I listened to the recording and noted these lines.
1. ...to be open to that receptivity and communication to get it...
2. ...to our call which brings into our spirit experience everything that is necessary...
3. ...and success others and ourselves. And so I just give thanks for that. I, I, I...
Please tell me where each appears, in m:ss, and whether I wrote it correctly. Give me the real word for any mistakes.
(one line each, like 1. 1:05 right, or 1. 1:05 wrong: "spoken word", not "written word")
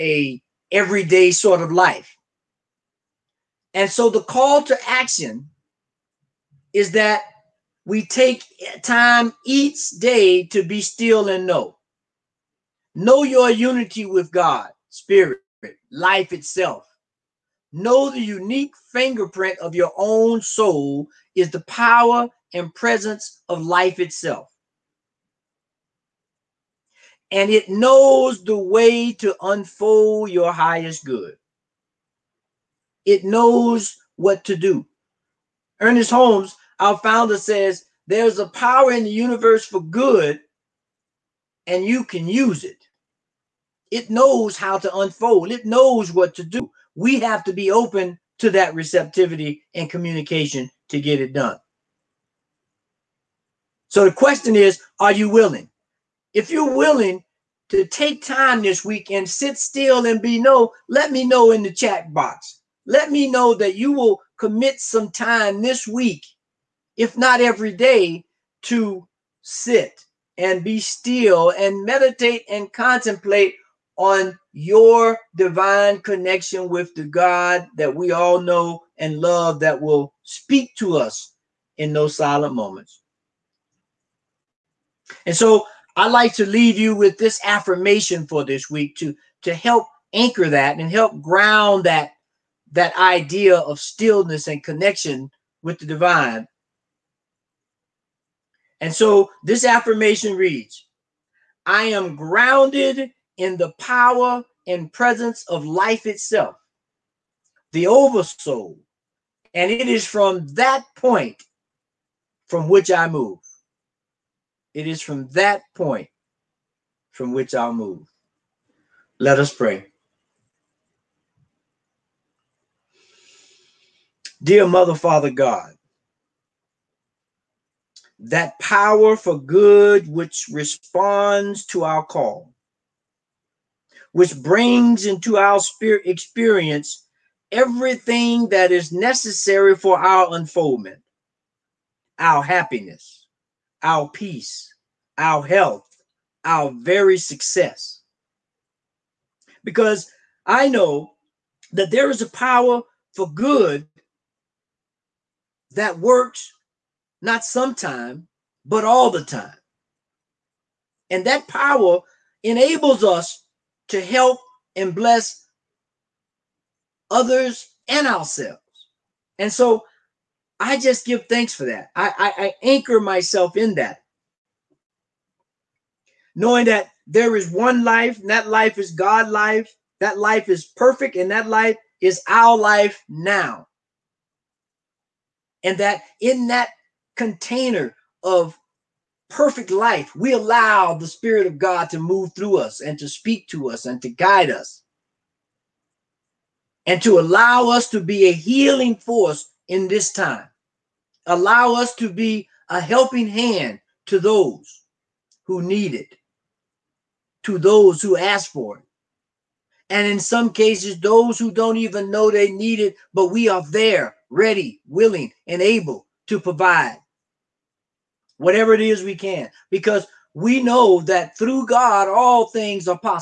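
1. 0:47 right
2. 2:11 right
3. 2:44 wrong: "bless", not "success".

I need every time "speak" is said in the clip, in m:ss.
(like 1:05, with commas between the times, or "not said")
1:20, 3:13.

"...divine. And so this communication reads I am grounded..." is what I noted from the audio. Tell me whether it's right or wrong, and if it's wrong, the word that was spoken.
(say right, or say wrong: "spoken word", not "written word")
wrong: "affirmation", not "communication".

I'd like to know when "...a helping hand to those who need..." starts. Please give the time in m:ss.
3:22.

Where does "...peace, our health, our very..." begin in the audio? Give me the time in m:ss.
2:24.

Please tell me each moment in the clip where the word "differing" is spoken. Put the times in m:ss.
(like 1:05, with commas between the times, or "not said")
not said.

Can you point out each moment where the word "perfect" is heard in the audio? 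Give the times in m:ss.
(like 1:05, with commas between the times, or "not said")
3:00, 3:09.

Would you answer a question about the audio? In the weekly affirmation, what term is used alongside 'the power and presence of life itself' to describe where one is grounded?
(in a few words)
The oversoul.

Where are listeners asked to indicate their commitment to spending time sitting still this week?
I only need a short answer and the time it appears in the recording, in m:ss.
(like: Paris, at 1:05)
The chat box, at 1:01.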